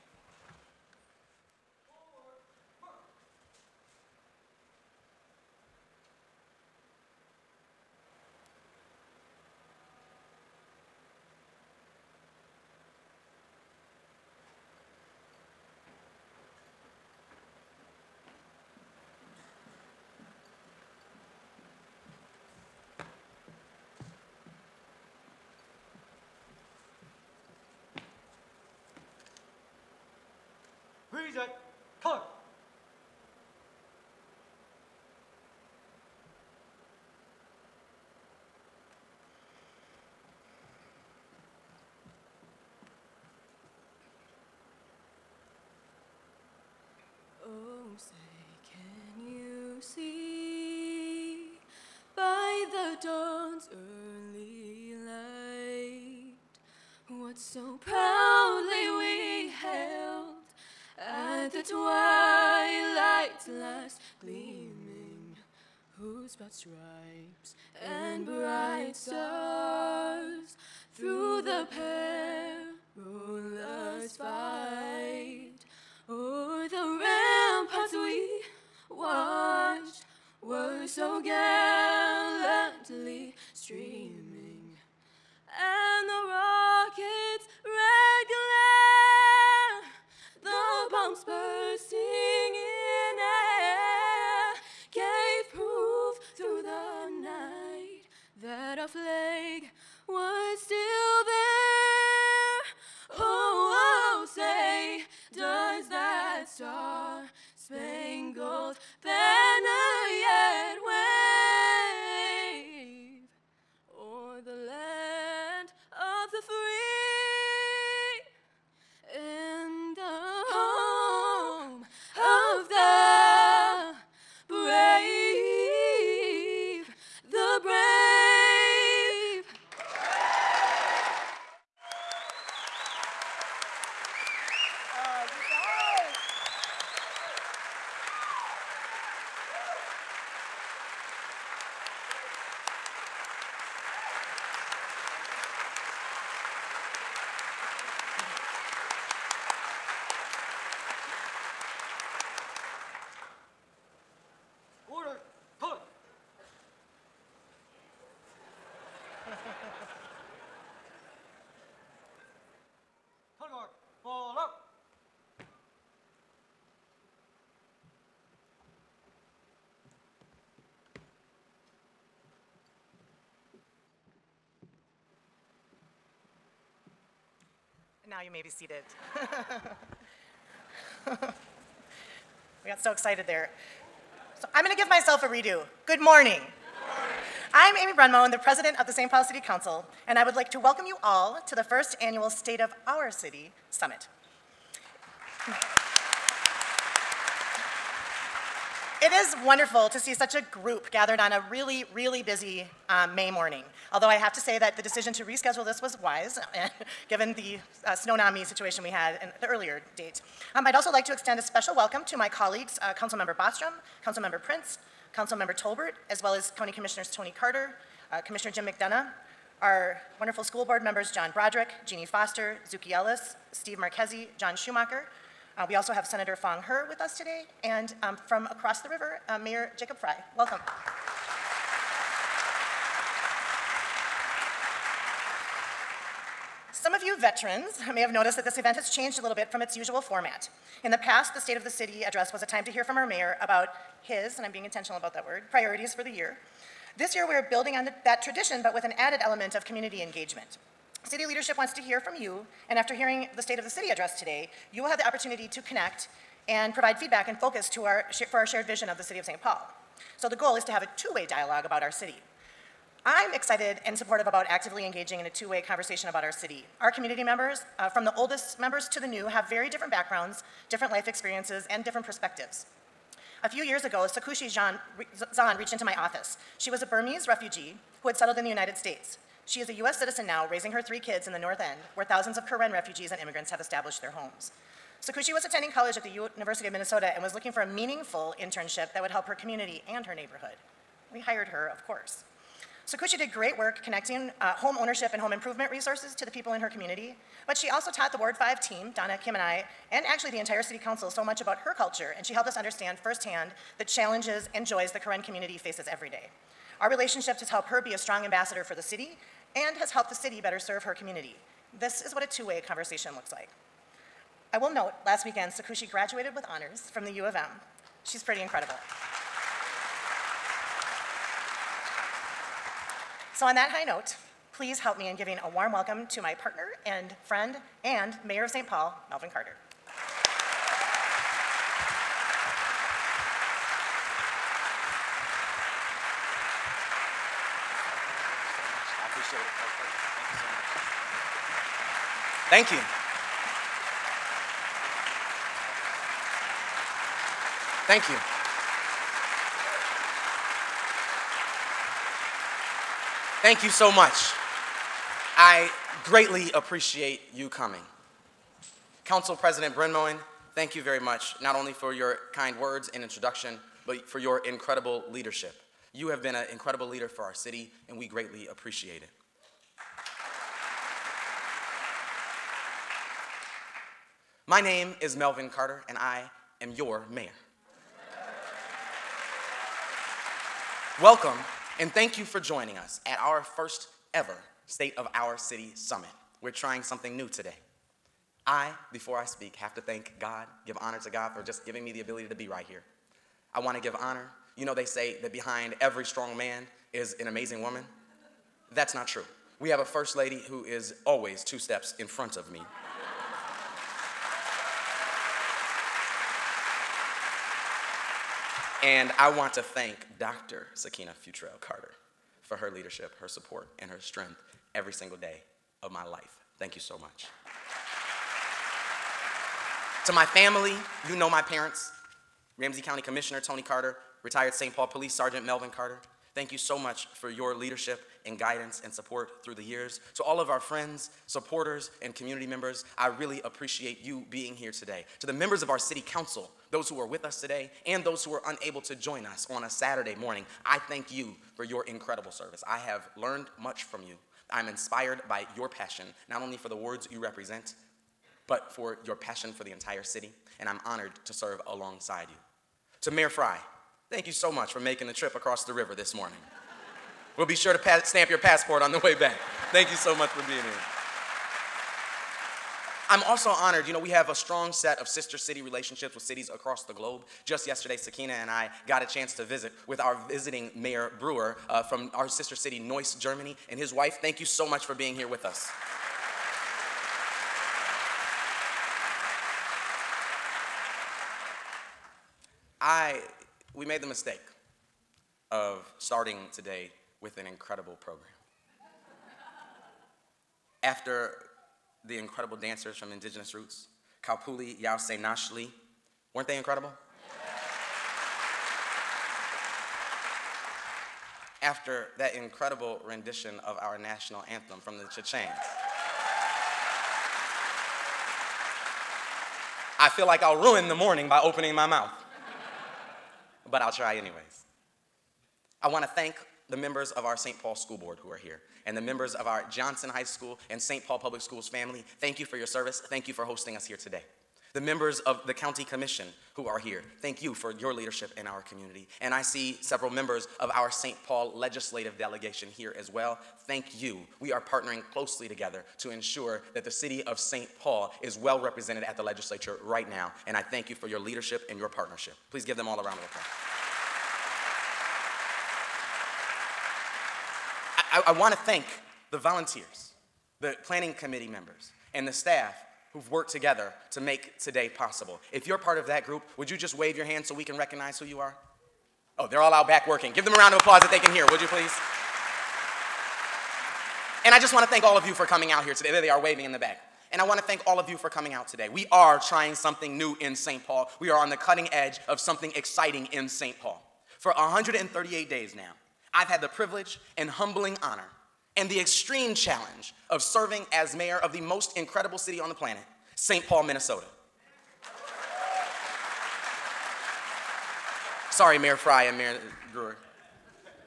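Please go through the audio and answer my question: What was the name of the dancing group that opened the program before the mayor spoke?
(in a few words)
Indigenous Roots.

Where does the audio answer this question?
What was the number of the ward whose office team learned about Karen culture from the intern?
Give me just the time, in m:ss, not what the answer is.
4:58.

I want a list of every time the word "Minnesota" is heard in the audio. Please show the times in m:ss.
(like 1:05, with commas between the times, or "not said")
4:46, 9:43.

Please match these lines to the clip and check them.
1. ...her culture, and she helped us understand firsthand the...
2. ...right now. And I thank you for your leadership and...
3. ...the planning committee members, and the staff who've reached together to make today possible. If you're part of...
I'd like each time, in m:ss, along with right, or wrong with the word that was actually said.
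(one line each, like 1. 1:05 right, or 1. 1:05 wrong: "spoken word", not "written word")
1. 5:01 right
2. 8:59 right
3. 9:10 wrong: "worked", not "reached".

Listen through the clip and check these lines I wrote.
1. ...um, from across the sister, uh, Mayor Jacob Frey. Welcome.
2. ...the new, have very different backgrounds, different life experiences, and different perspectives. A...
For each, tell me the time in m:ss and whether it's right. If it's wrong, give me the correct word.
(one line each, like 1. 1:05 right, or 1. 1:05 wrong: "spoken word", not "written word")
1. 3:48 wrong: "river", not "sister"
2. 4:28 right.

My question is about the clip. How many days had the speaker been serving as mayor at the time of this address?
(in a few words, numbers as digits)
138.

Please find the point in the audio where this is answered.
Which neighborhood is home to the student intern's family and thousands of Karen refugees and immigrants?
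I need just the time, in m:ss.
4:41.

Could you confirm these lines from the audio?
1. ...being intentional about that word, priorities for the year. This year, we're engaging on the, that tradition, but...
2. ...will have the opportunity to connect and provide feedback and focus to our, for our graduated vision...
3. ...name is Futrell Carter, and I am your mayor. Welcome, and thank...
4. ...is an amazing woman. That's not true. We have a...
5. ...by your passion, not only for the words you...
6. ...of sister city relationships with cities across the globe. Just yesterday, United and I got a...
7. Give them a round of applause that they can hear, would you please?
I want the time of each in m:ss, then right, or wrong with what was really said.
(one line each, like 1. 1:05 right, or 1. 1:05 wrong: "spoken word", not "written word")
1. 4:04 wrong: "building", not "engaging"
2. 4:14 wrong: "shared", not "graduated"
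3. 6:14 wrong: "Melvin", not "Futrell"
4. 6:36 right
5. 7:25 right
6. 7:44 wrong: "Sakina", not "United"
7. 9:20 right.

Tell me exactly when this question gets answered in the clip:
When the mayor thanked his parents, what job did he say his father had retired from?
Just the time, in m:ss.
7:04.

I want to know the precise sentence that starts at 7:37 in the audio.
we'll be sure to stamp your passport on the way back.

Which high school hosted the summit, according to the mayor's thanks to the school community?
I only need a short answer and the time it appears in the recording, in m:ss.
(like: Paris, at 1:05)
Johnson High School, at 8:39.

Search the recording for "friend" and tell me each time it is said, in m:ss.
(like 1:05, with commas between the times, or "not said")
5:27, 7:10.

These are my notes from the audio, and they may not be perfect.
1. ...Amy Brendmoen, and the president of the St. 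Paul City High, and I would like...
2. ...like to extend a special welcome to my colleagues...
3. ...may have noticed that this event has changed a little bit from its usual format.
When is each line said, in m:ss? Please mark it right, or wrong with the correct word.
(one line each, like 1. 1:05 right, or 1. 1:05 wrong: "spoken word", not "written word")
1. 3:07 wrong: "Council", not "High"
2. 3:30 right
3. 3:57 right.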